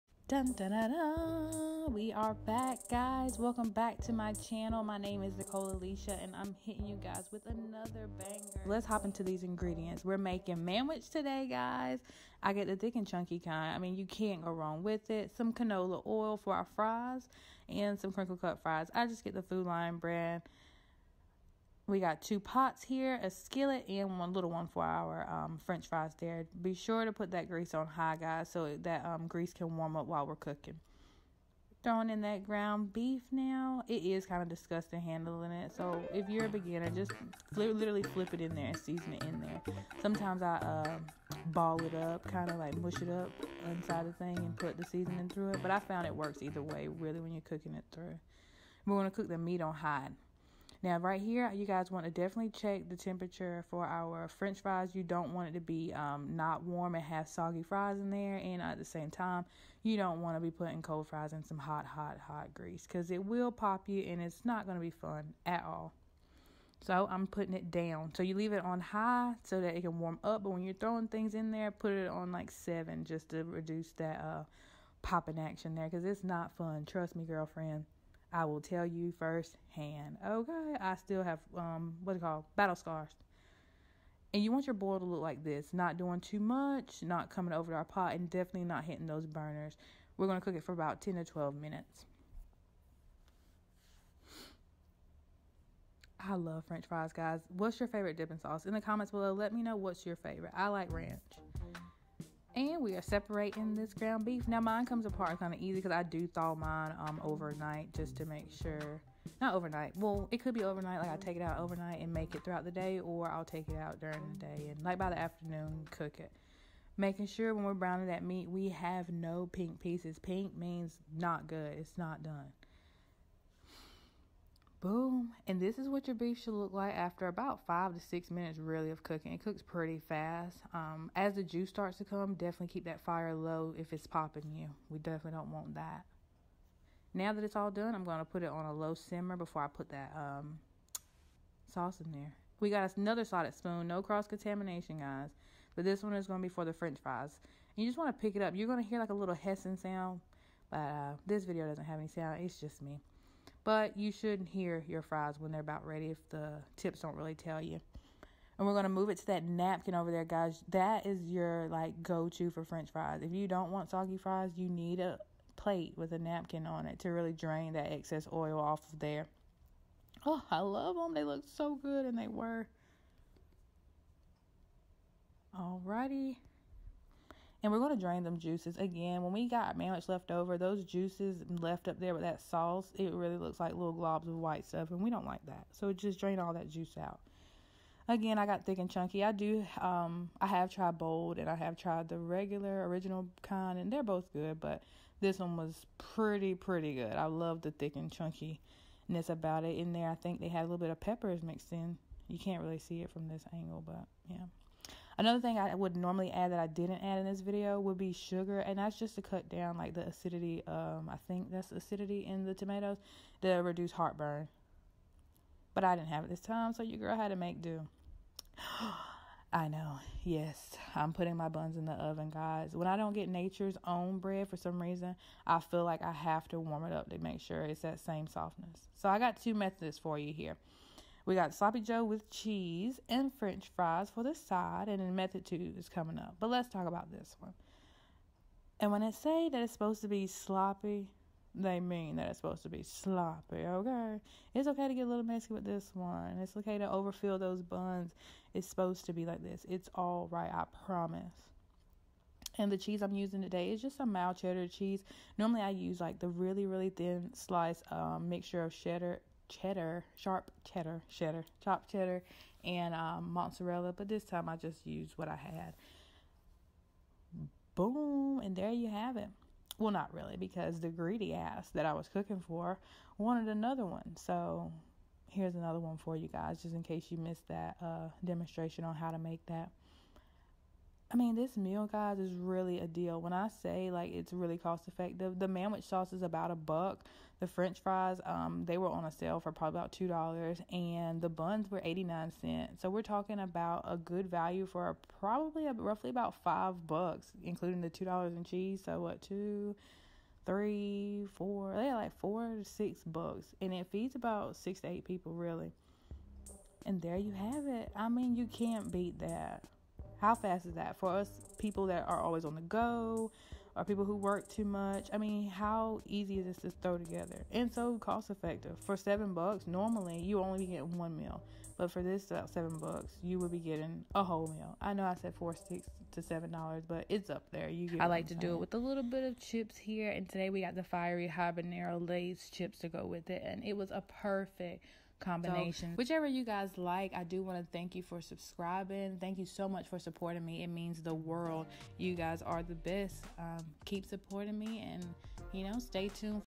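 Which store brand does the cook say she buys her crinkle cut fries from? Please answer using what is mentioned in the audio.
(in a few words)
Food Lion.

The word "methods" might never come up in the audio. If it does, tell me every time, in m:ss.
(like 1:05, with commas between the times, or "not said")
3:49, 3:55.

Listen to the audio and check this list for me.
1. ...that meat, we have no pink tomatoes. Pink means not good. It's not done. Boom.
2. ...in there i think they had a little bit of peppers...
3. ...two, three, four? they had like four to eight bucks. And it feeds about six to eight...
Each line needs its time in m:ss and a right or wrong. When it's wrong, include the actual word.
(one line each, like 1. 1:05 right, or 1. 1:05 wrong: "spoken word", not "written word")
1. 1:58 wrong: "pieces", not "tomatoes"
2. 3:19 right
3. 4:59 wrong: "six", not "eight".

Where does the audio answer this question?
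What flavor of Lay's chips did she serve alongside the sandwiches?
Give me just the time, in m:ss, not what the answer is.
5:30.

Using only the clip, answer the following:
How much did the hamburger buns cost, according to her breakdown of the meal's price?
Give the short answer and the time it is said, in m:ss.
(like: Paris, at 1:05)
89 cents, at 4:51.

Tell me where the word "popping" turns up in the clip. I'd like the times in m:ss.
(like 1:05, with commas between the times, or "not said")
1:15, 2:14.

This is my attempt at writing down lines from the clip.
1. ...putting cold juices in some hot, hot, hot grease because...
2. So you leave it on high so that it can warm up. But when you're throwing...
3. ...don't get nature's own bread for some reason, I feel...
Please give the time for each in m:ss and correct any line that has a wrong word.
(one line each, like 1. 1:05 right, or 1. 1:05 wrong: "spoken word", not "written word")
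1. 1:00 wrong: "fries", not "juices"
2. 1:08 right
3. 3:42 right.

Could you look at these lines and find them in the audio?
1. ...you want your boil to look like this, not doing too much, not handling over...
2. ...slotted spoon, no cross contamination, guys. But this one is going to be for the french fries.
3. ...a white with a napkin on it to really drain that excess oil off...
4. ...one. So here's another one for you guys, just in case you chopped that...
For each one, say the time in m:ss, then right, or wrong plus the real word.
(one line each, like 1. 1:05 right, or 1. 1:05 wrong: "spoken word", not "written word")
1. 1:24 wrong: "coming", not "handling"
2. 2:23 right
3. 2:44 wrong: "plate", not "white"
4. 4:33 wrong: "missed", not "chopped".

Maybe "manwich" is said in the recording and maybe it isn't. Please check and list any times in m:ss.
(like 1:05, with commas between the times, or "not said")
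0:10, 2:59, 4:45.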